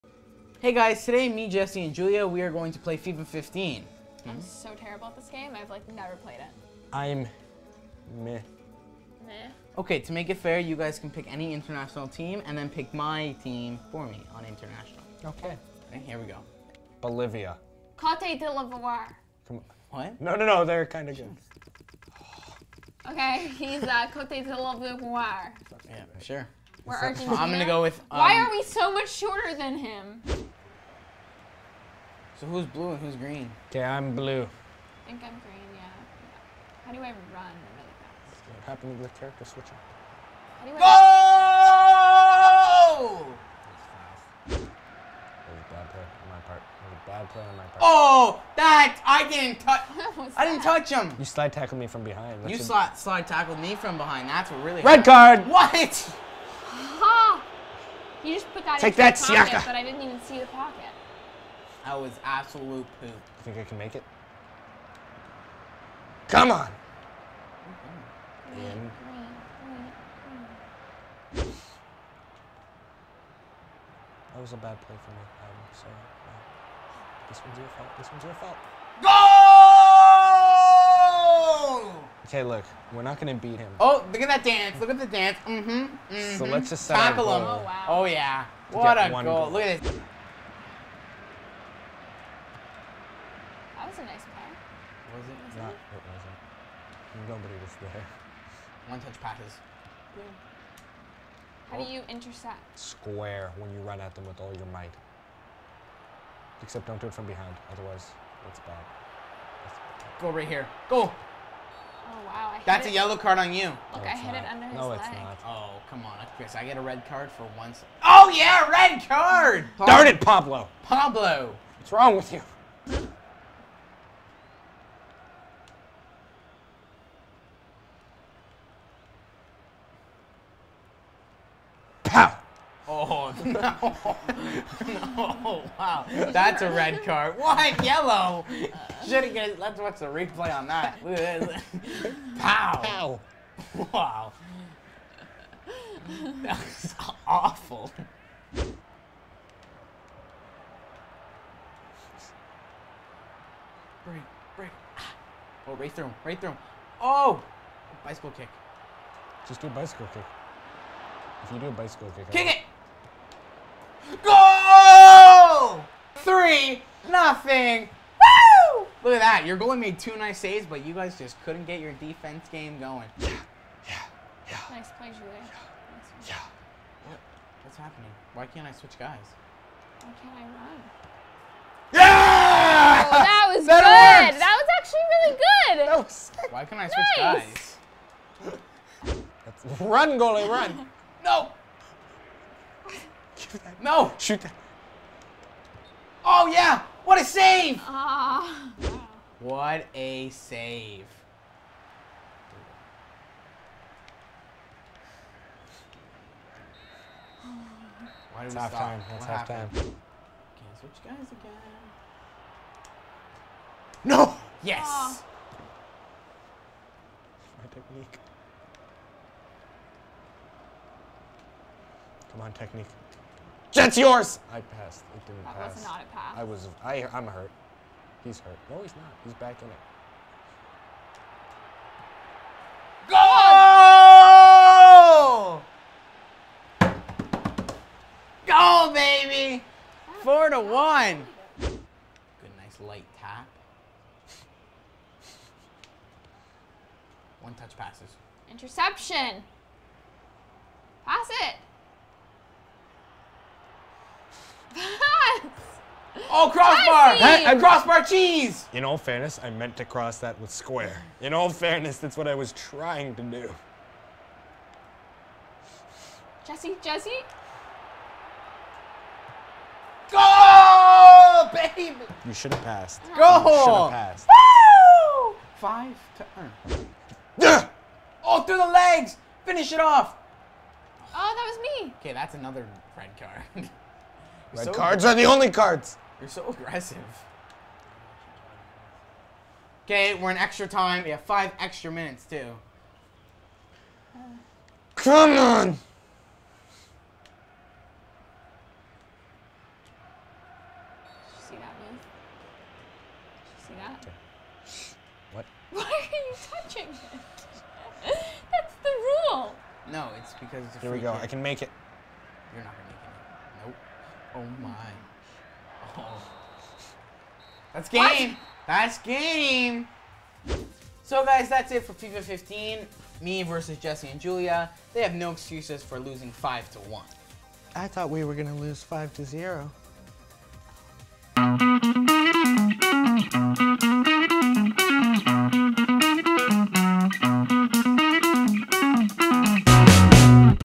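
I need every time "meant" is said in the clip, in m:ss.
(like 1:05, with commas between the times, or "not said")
4:19.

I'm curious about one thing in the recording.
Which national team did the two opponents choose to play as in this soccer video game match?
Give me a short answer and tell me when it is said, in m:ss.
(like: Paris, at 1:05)
Argentina, at 0:26.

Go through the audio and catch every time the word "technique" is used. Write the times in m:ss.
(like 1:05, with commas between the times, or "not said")
3:37, 3:42.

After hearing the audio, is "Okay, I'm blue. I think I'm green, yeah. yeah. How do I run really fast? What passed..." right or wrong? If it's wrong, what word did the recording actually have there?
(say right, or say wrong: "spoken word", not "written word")
wrong: "happened", not "passed".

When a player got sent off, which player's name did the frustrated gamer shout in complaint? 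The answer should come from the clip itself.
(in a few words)
Pablo.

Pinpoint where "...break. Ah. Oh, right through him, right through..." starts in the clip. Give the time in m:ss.
2:34.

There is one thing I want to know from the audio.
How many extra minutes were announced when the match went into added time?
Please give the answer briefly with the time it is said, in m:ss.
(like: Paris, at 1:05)
5, at 4:51.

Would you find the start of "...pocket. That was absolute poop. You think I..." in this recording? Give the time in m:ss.
1:00.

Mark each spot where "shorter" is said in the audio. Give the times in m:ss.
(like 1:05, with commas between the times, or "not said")
0:29.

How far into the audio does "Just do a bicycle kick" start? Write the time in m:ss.
2:39.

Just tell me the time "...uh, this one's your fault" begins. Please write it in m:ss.
1:16.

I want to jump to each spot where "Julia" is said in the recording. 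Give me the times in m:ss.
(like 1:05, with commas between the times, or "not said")
0:01, 2:55, 5:24.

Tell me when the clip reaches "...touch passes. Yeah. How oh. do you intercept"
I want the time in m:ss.
1:38.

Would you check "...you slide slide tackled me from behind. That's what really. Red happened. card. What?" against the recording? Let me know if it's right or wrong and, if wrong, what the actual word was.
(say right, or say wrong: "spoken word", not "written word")
right.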